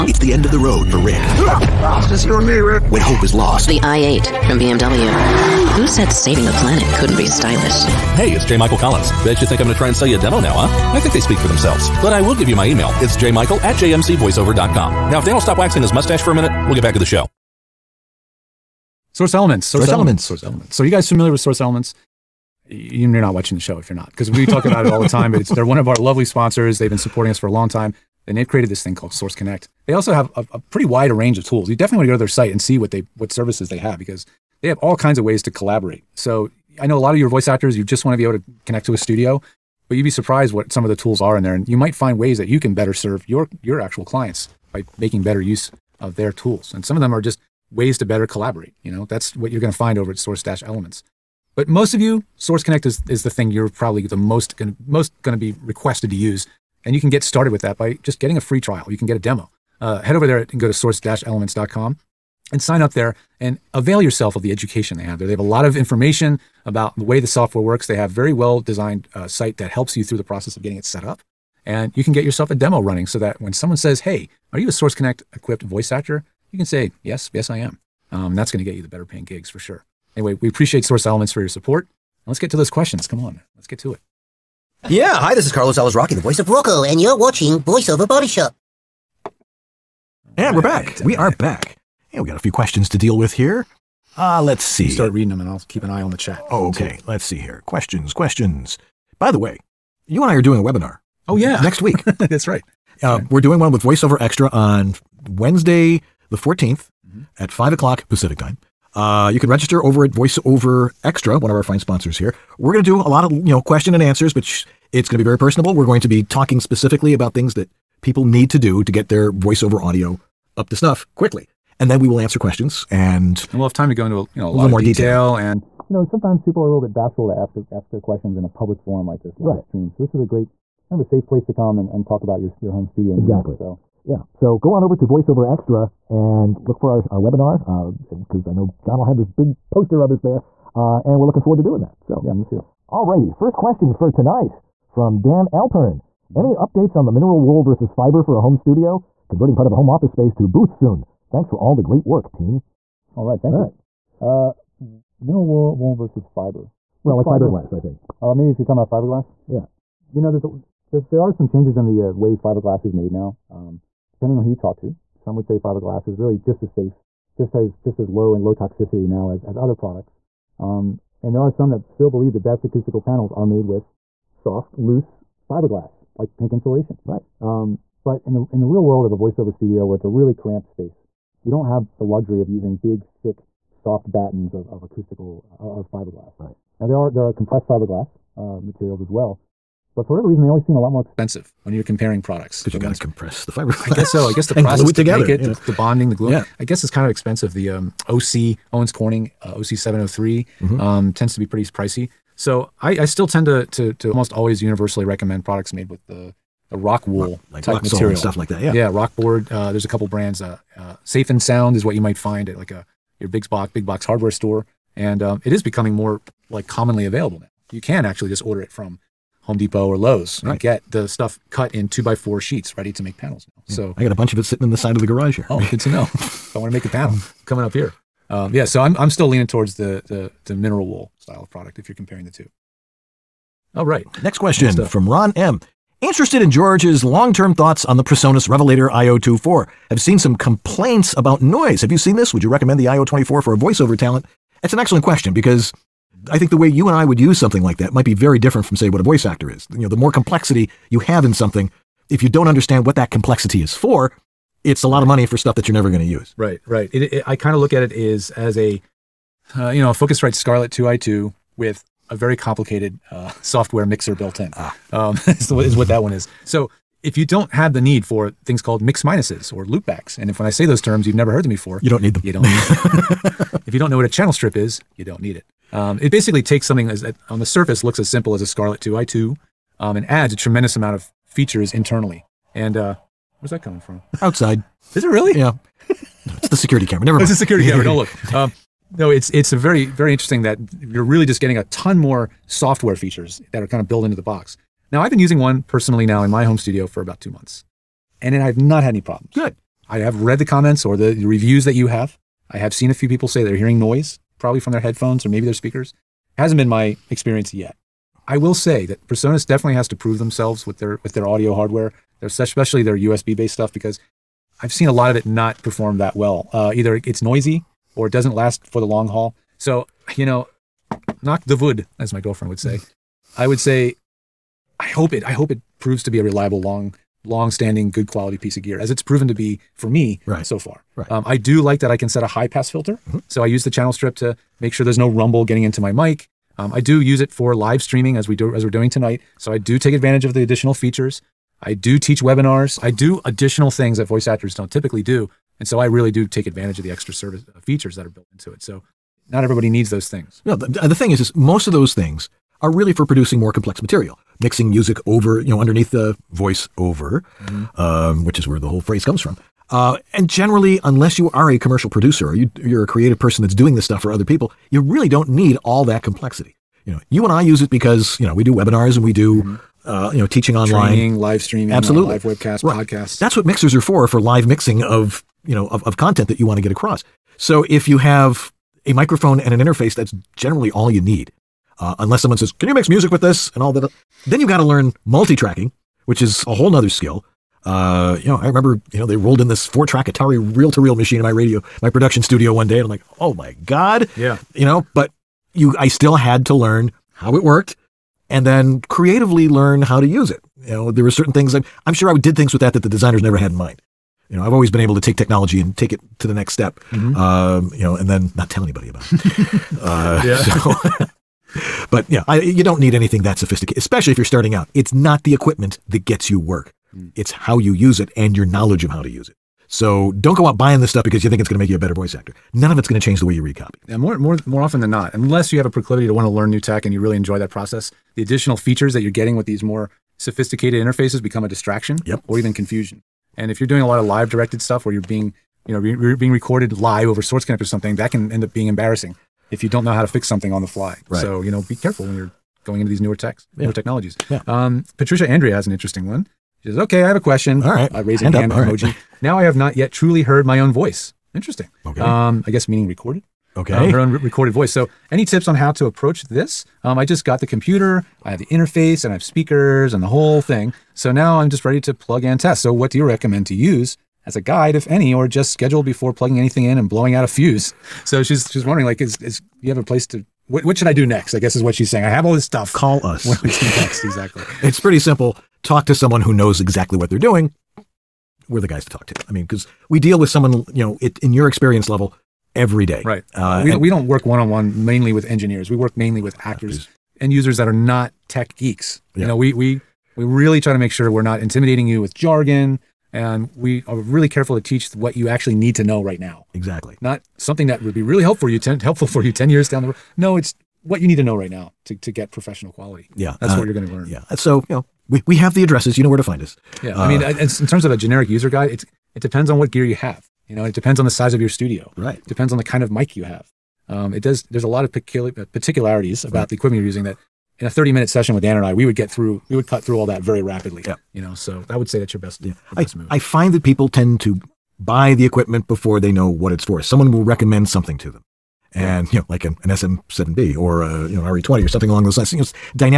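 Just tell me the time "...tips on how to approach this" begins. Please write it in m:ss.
7:35.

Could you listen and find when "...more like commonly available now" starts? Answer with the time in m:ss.
3:35.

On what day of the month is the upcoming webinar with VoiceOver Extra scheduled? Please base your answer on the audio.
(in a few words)
14th.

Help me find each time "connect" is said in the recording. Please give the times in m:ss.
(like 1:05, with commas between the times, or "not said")
0:29, 0:38, 0:52, 1:14, 7:17.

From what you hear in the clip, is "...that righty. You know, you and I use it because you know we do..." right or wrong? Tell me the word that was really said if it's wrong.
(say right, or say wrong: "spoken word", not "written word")
wrong: "complexity", not "righty".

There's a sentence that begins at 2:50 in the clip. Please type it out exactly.
Um, and there are some that still believe the best acoustical panels are made with soft, loose fiberglass, like pink insulation.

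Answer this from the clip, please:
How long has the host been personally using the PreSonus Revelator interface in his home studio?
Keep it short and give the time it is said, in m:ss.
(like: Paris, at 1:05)
about two months, at 4:57.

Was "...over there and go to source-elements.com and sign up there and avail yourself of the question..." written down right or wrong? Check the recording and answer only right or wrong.
wrong.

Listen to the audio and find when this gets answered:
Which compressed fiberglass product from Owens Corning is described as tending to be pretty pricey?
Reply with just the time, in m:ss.
3:19.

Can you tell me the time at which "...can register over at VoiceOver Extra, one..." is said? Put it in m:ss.
1:49.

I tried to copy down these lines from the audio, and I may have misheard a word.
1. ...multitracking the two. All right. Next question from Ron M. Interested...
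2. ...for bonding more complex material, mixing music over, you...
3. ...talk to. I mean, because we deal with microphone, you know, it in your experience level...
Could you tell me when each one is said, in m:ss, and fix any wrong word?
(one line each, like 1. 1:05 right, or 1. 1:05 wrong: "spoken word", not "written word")
1. 3:51 wrong: "comparing", not "multitracking"
2. 5:52 wrong: "producing", not "bonding"
3. 7:58 wrong: "someone", not "microphone".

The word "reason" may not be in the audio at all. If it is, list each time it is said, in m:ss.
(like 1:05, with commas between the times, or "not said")
3:10.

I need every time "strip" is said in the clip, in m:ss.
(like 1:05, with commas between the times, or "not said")
4:34, 5:33.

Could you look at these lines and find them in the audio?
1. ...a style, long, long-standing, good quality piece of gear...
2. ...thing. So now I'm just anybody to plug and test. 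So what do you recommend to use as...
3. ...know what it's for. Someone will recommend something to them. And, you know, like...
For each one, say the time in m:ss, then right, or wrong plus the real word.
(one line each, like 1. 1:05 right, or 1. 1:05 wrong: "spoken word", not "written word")
1. 5:26 wrong: "reliable", not "style"
2. 7:40 wrong: "ready", not "anybody"
3. 8:46 right.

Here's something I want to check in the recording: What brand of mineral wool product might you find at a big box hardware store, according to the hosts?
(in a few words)
Safe and Sound.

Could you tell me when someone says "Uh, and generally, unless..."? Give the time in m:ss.
5:59.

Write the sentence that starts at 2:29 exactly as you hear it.
Converting part of a home office space to booth soon.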